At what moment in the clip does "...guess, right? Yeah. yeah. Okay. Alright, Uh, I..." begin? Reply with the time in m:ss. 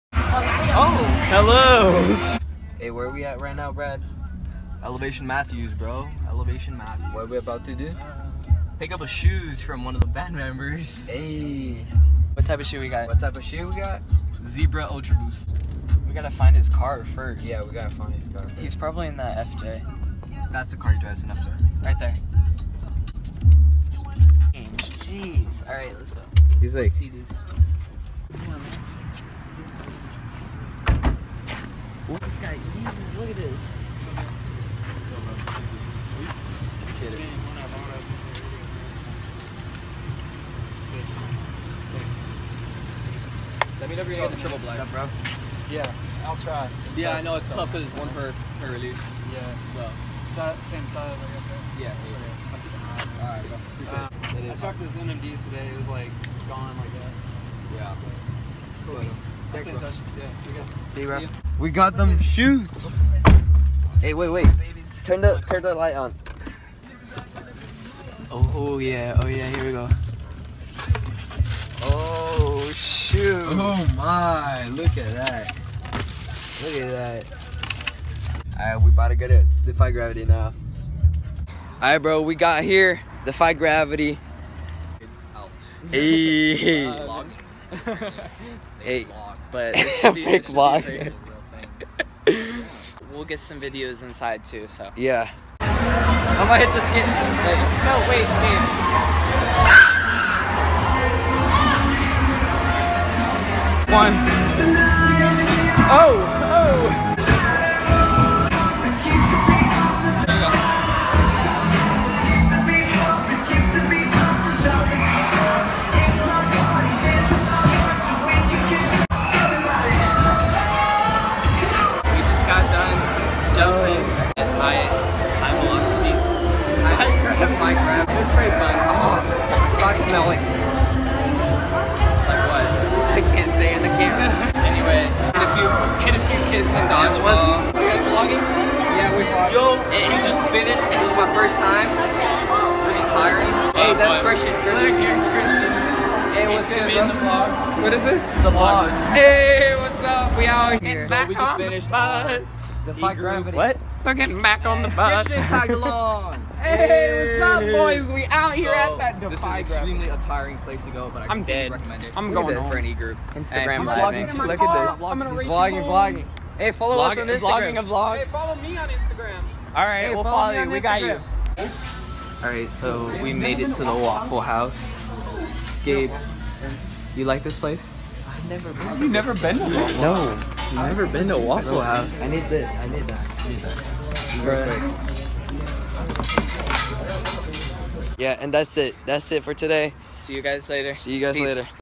0:51.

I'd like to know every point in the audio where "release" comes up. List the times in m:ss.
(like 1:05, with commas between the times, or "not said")
0:48.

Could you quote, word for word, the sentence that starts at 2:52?
All right, so we made it to the Waffle House.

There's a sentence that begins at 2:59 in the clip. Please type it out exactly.
You've never been to Waffle House?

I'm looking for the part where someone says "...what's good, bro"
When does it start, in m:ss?
2:26.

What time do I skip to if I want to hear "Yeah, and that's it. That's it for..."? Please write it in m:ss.
3:08.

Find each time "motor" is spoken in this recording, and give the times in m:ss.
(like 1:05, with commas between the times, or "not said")
not said.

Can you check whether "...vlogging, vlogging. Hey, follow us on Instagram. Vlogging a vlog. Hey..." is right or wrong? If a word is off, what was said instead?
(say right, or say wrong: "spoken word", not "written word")
right.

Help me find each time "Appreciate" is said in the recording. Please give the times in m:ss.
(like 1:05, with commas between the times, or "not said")
0:36.